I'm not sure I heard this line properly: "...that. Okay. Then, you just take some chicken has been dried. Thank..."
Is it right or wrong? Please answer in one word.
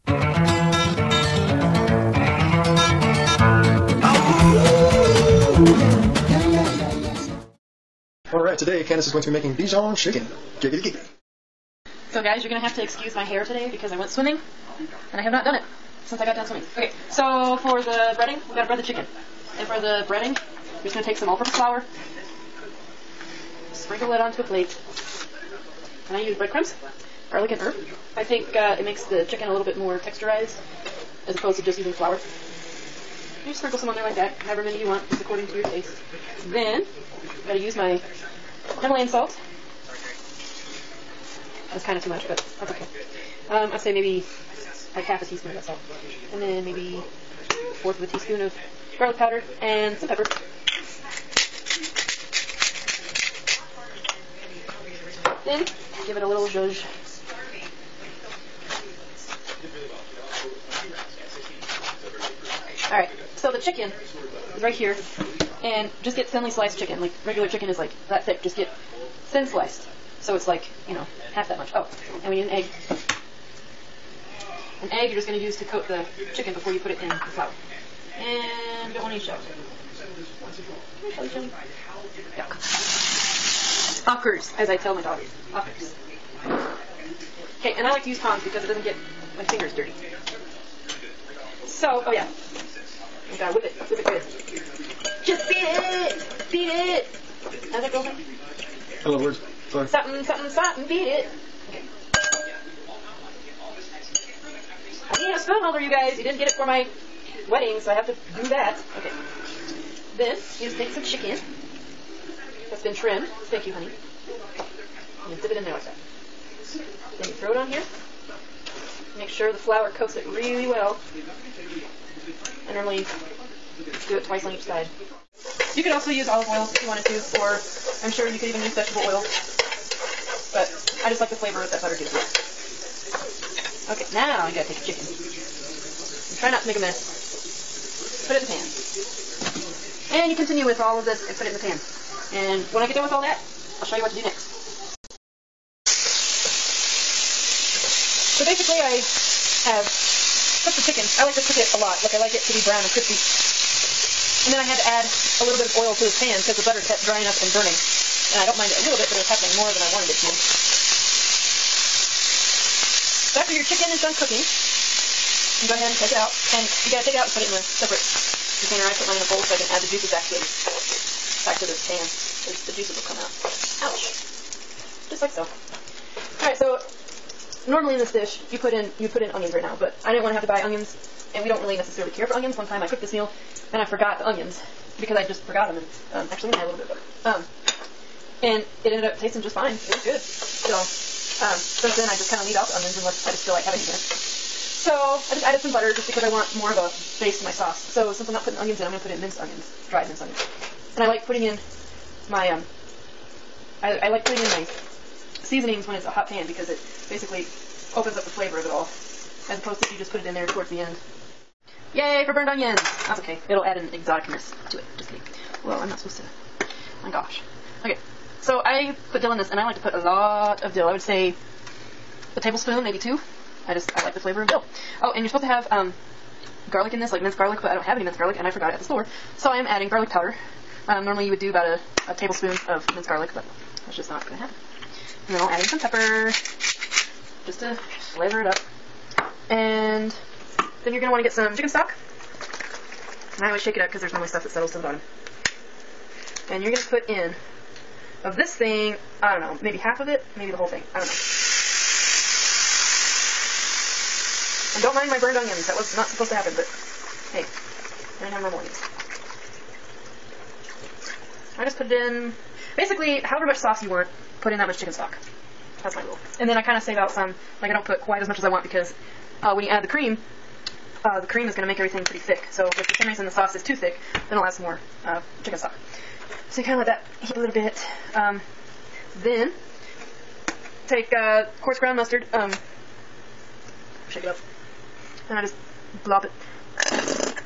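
wrong.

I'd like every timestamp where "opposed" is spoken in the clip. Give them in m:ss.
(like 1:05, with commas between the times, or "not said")
0:31, 3:29.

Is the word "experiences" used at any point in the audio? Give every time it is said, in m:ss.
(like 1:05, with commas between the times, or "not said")
not said.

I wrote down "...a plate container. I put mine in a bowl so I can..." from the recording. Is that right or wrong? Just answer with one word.
wrong.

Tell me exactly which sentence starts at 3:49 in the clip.
So I am adding garlic powder.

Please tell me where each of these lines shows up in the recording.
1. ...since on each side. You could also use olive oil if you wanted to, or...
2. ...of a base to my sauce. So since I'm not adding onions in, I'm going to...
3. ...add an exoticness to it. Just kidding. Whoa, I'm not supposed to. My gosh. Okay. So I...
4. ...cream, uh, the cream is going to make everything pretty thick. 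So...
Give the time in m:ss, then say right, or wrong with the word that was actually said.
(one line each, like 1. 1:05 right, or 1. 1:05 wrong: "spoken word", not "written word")
1. 2:04 wrong: "twice", not "since"
2. 3:16 wrong: "putting", not "adding"
3. 3:33 right
4. 4:29 right.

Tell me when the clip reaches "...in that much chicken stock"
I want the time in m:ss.
4:24.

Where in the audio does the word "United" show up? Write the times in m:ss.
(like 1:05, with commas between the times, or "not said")
not said.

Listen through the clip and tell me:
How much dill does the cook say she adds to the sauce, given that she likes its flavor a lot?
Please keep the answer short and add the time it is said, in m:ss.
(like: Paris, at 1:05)
a tablespoon, maybe 2, at 3:42.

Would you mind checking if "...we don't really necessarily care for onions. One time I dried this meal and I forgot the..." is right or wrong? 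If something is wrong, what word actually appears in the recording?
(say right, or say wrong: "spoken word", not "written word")
wrong: "cooked", not "dried".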